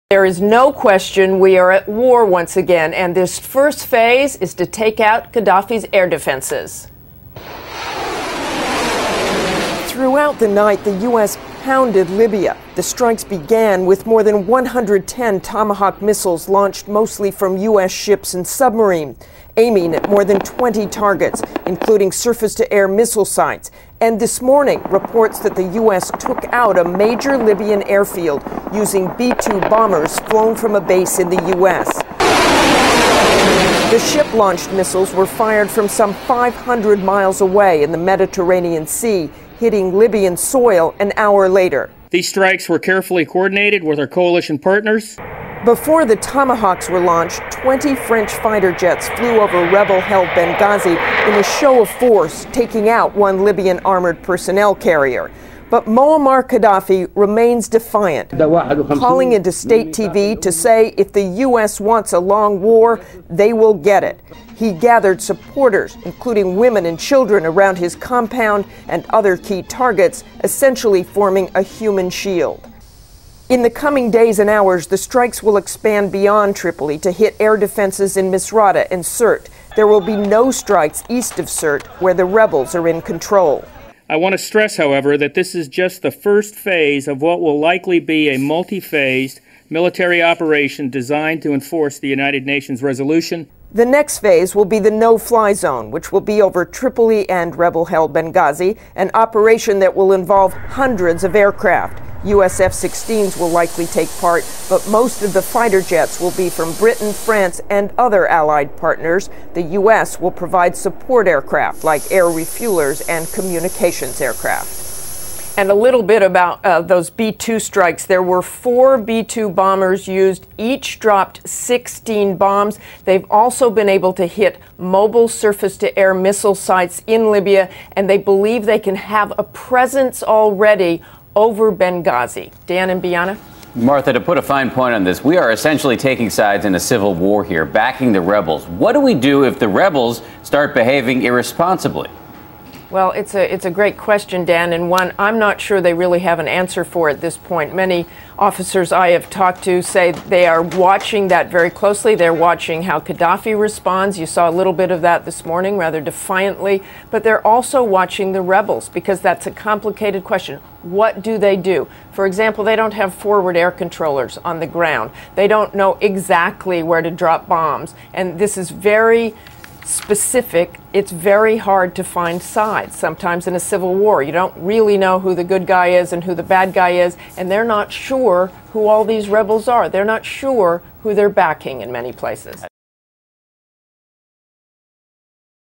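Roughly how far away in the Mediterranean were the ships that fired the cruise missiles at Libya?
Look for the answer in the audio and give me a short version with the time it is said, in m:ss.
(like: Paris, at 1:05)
500 miles, at 0:36.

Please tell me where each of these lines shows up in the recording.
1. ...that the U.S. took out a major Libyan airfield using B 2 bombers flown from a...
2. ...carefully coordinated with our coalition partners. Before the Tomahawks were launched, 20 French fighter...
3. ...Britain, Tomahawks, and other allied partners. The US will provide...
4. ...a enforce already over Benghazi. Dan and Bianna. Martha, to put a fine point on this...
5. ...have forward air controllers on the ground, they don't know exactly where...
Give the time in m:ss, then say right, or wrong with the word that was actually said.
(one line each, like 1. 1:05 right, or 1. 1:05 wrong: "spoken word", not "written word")
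1. 0:25 right
2. 0:42 right
3. 1:46 wrong: "France", not "Tomahawks"
4. 2:09 wrong: "presence", not "enforce"
5. 2:42 right.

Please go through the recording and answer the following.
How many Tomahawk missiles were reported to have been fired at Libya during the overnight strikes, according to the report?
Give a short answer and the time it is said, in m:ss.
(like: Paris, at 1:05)
more than 110, at 0:14.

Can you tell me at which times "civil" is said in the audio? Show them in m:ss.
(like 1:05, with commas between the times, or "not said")
2:16, 2:53.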